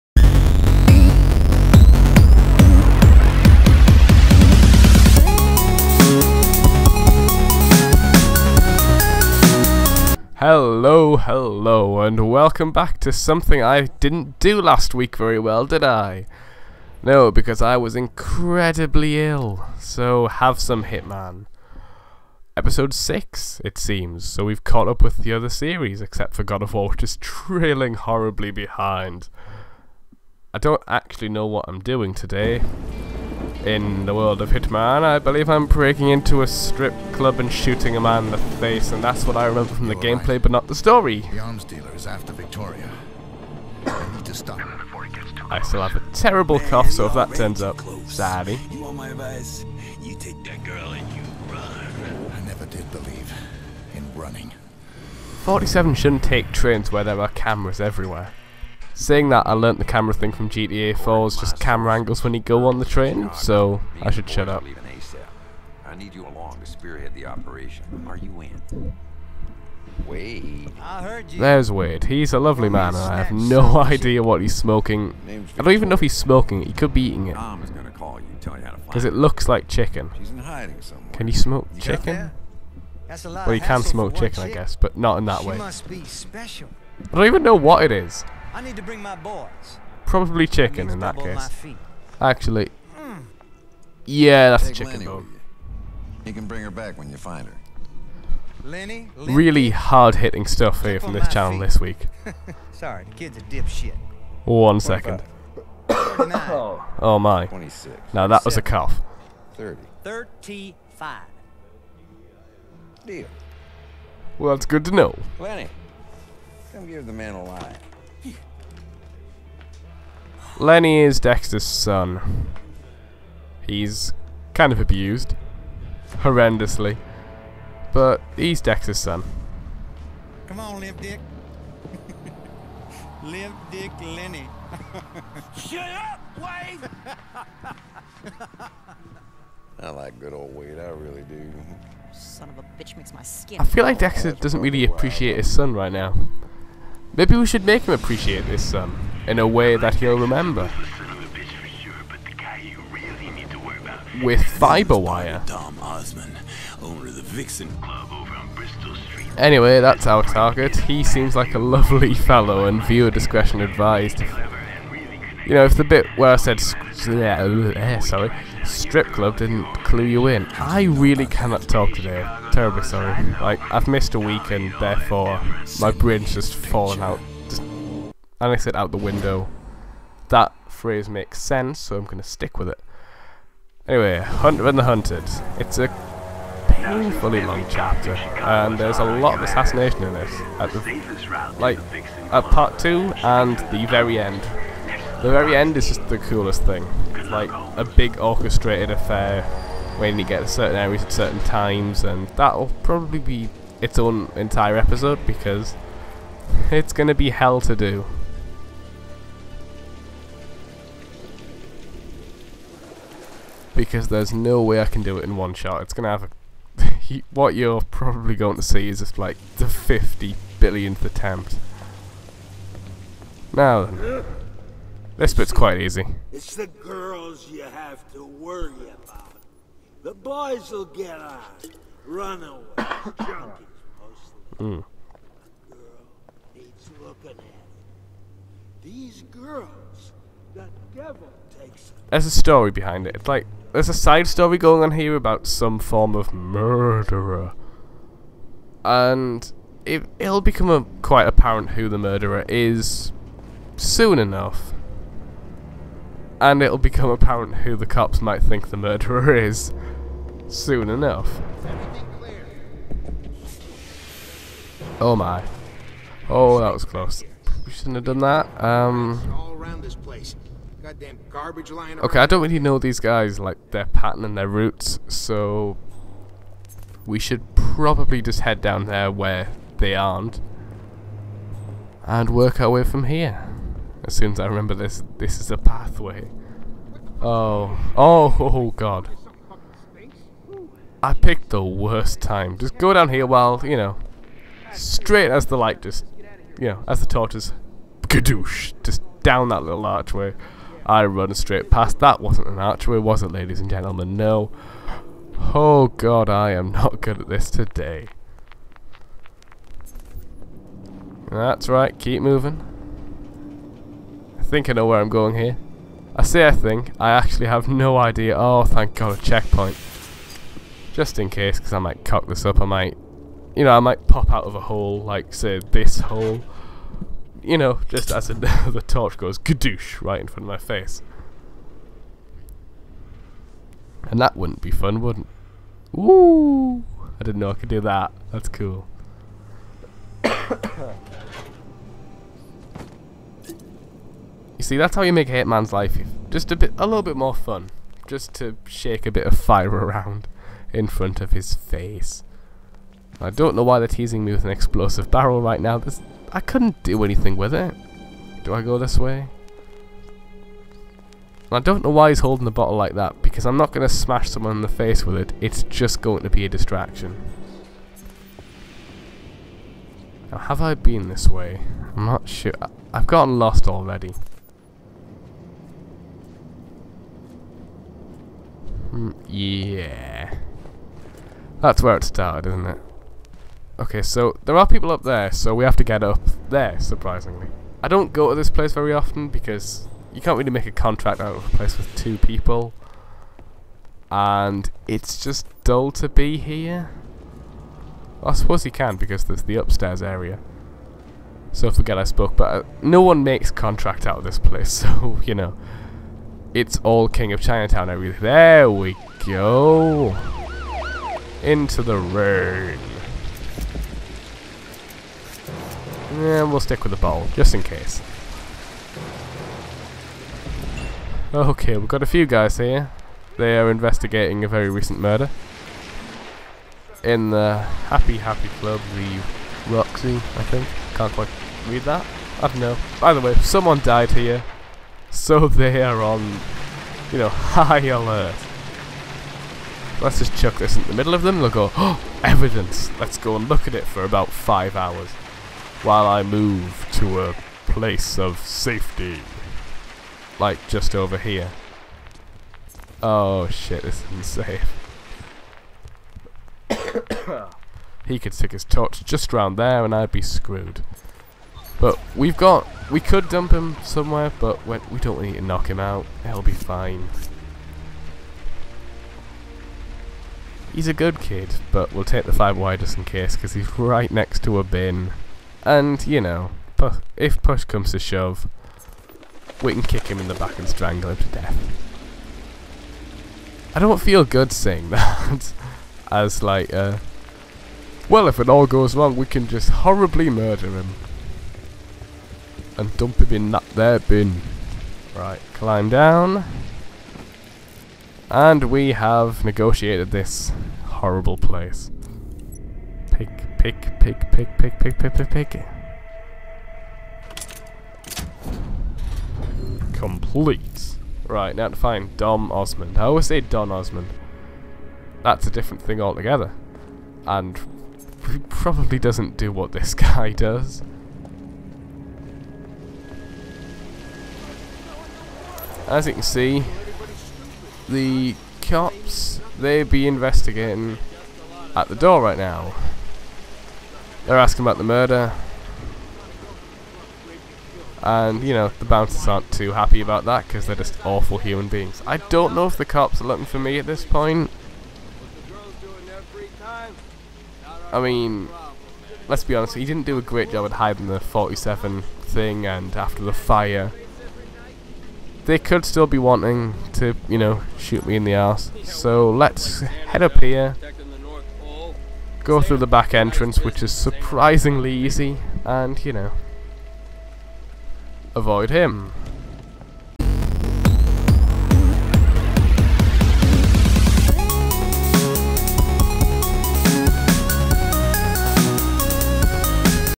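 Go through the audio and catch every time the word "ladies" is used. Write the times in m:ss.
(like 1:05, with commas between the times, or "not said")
5:03.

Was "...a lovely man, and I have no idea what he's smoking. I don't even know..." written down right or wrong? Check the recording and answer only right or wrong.
right.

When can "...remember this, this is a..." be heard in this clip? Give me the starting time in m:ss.
4:44.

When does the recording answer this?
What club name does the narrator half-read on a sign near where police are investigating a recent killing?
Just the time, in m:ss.
7:08.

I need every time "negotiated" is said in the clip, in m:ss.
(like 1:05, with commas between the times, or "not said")
8:19.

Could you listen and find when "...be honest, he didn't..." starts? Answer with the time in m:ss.
9:09.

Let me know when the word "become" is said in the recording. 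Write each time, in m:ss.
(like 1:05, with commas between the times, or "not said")
4:10, 4:16.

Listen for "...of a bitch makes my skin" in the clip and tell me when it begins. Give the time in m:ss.
2:22.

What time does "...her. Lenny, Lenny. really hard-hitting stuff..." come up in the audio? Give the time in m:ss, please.
1:37.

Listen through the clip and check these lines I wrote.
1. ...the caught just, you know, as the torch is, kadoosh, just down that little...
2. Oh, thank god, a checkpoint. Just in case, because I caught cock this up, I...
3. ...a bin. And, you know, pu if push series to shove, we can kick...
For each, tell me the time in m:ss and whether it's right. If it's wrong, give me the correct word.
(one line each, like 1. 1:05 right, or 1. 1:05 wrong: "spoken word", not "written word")
1. 4:55 wrong: "light", not "caught"
2. 5:18 wrong: "might", not "caught"
3. 7:54 wrong: "comes", not "series".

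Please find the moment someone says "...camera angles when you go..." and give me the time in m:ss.
1:01.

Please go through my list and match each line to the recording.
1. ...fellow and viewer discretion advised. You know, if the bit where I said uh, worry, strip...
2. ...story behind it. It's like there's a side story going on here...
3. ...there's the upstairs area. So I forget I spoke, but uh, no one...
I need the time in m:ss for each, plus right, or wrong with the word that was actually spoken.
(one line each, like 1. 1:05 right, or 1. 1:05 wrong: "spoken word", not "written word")
1. 2:42 wrong: "sorry", not "worry"
2. 4:02 right
3. 6:39 right.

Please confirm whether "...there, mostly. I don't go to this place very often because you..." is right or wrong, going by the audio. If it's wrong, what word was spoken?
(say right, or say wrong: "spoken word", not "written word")
wrong: "surprisingly", not "mostly".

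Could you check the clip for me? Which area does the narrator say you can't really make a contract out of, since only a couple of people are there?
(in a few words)
King of Chinatown area.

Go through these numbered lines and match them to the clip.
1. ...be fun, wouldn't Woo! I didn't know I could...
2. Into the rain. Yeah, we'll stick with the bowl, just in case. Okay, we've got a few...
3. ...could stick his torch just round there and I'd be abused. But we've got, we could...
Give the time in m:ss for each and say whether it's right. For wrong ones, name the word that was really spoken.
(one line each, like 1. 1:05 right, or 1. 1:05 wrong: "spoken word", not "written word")
1. 5:34 right
2. 6:51 right
3. 7:38 wrong: "screwed", not "abused".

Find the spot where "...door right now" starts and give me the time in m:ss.
8:51.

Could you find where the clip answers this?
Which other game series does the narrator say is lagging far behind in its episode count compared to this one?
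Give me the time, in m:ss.
0:26.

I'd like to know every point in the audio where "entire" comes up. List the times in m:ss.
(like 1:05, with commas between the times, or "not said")
3:24.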